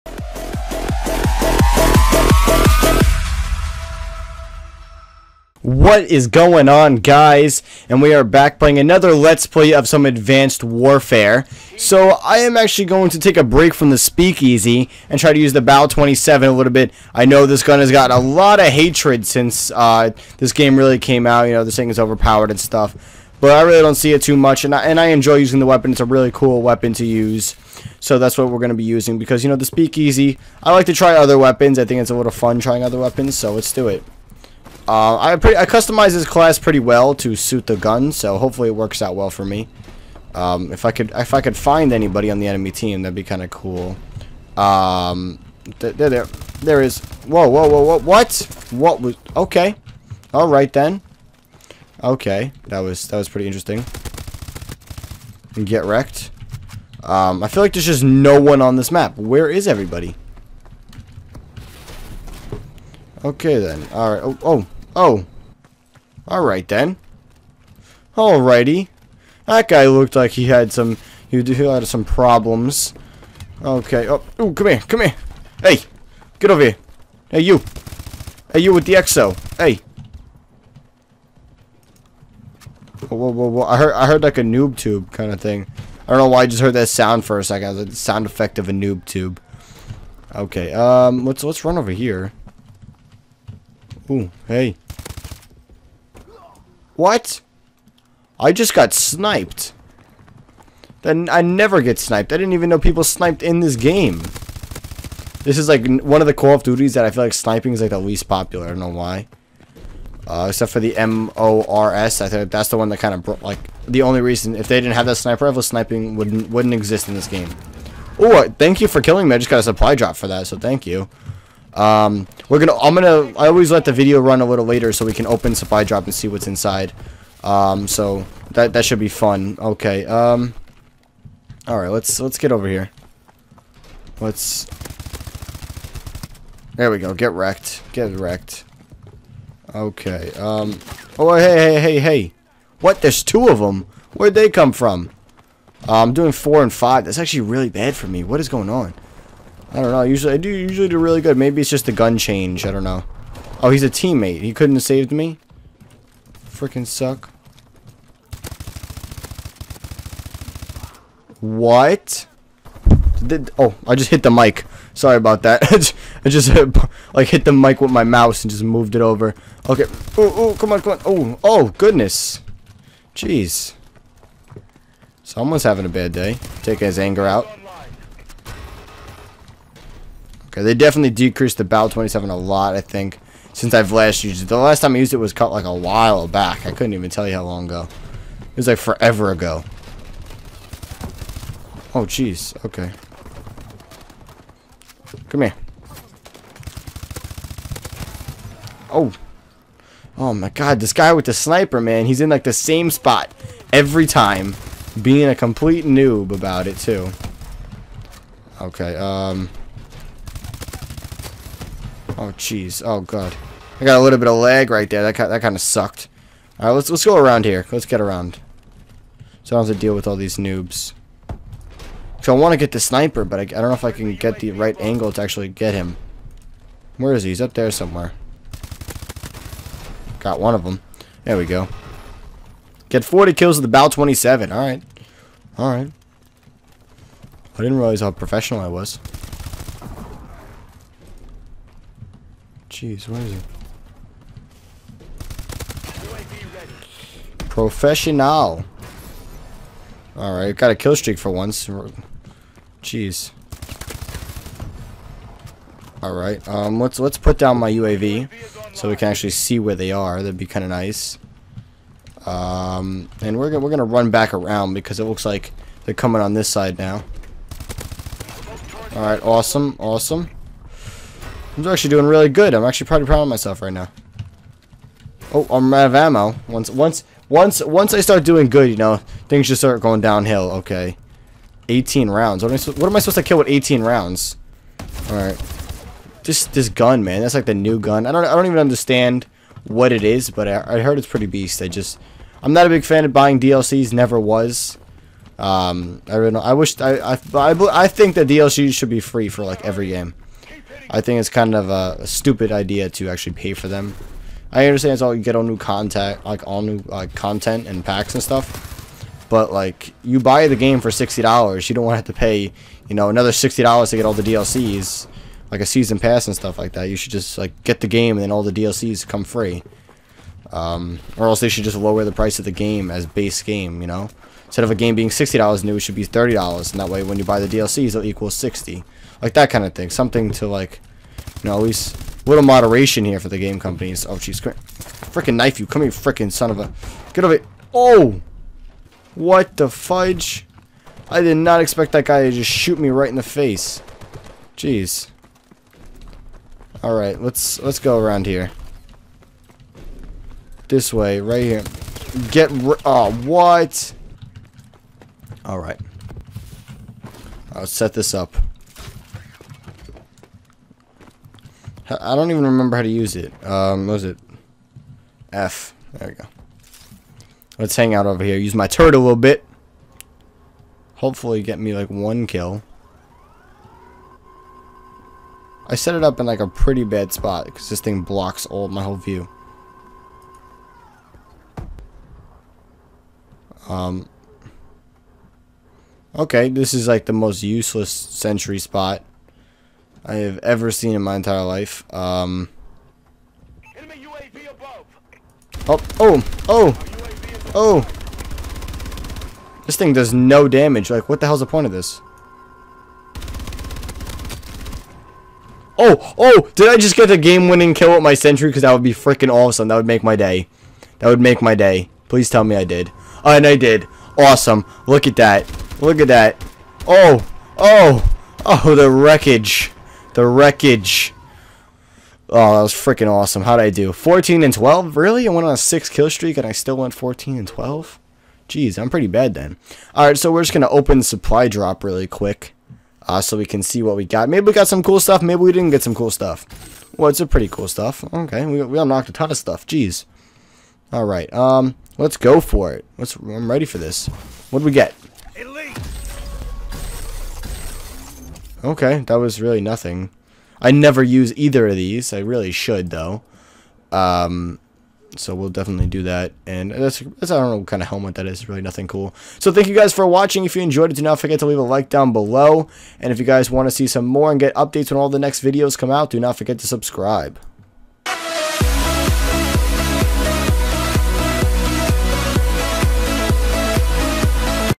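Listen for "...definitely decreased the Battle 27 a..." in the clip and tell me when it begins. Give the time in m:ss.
3:00.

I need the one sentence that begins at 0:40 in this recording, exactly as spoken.
Um, if I could, if I could find anybody on the enemy team, that'd be kind of cool.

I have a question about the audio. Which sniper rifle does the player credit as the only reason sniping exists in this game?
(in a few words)
MORS.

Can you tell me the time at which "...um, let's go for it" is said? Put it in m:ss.
7:21.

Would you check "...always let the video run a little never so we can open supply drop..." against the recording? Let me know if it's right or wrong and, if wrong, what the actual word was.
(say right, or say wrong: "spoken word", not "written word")
wrong: "later", not "never".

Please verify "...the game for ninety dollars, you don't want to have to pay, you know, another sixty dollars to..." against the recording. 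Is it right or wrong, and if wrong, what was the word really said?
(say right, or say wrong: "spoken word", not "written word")
wrong: "sixty", not "ninety".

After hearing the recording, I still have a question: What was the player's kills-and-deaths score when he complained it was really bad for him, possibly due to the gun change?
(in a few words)
4 and 5.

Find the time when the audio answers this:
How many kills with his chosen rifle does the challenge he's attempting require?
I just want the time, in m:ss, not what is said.
3:53.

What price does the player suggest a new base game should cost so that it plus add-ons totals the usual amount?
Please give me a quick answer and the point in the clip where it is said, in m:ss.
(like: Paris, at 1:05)
$30, at 5:26.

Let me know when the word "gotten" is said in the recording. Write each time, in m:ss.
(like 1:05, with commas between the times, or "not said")
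0:17.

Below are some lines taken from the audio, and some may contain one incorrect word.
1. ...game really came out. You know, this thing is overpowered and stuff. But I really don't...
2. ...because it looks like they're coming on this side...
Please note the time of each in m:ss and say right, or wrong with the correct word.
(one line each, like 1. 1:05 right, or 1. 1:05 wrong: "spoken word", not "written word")
1. 0:20 right
2. 4:24 right.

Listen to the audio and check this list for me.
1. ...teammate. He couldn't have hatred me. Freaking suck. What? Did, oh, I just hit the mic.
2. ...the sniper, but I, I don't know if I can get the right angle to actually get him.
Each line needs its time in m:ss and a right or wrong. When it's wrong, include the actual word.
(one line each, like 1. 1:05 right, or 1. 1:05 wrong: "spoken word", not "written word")
1. 2:33 wrong: "saved", not "hatred"
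2. 3:42 right.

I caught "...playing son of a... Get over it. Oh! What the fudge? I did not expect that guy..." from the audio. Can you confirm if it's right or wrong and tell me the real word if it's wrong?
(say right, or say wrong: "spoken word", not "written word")
wrong: "freaking", not "playing".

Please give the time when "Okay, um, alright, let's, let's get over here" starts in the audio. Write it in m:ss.
2:09.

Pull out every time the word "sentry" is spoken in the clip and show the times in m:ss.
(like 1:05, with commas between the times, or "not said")
6:27, 6:48.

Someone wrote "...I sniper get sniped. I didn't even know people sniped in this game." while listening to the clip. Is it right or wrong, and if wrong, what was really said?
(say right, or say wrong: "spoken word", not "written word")
wrong: "never", not "sniper".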